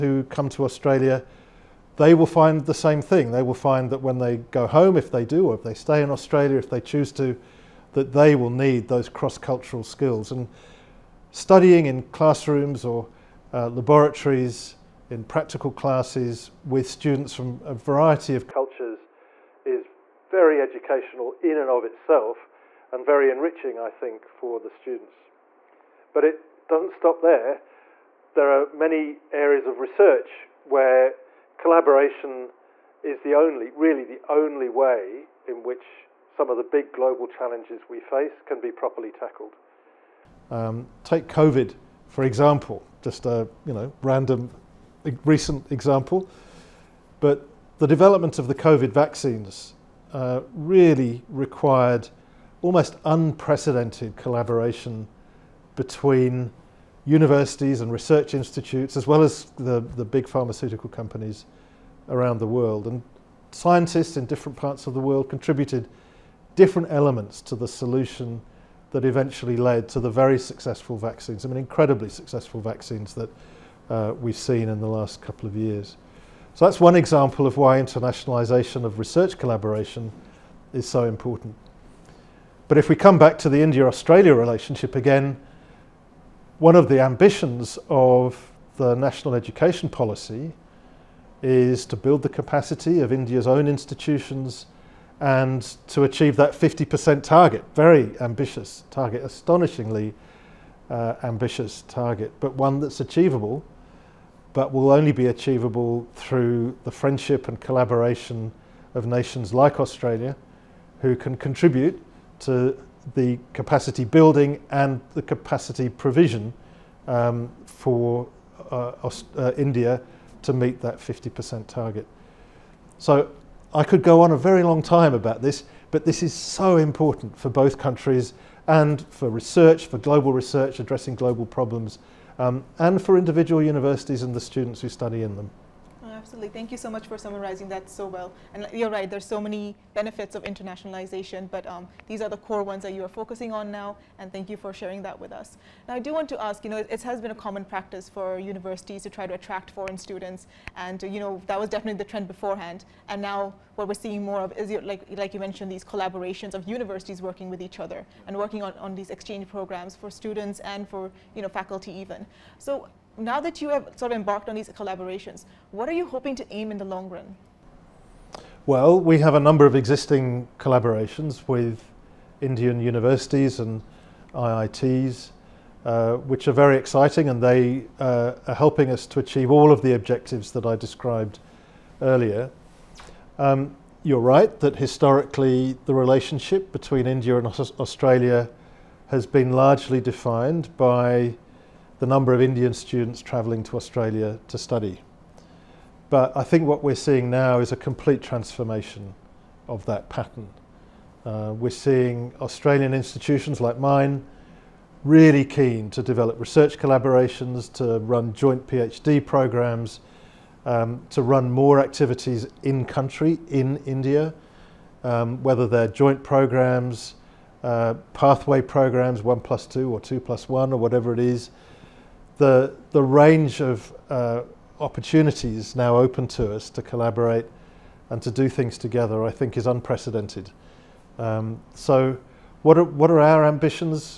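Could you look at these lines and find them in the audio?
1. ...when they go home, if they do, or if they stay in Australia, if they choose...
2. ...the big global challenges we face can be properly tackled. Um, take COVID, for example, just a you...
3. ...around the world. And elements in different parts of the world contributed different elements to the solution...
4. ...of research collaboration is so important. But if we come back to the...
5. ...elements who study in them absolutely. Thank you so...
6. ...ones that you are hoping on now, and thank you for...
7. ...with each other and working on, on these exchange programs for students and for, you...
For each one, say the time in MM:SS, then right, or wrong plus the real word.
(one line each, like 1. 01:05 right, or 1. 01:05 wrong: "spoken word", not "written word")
1. 00:04 right
2. 00:36 right
3. 01:02 wrong: "scientists", not "elements"
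4. 01:18 right
5. 02:14 wrong: "students", not "elements"
6. 02:22 wrong: "focusing", not "hoping"
7. 02:37 right.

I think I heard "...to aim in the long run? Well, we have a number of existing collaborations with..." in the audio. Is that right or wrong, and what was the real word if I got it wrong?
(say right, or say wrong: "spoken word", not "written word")
right.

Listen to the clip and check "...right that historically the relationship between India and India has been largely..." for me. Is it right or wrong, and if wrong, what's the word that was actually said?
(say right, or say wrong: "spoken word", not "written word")
wrong: "Australia", not "India".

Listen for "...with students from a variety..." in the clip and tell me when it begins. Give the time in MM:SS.
00:16.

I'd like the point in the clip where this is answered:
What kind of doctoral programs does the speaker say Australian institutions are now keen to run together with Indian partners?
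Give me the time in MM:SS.
03:28.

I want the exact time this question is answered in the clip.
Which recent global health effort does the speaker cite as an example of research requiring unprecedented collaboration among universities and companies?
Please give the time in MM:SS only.
00:48.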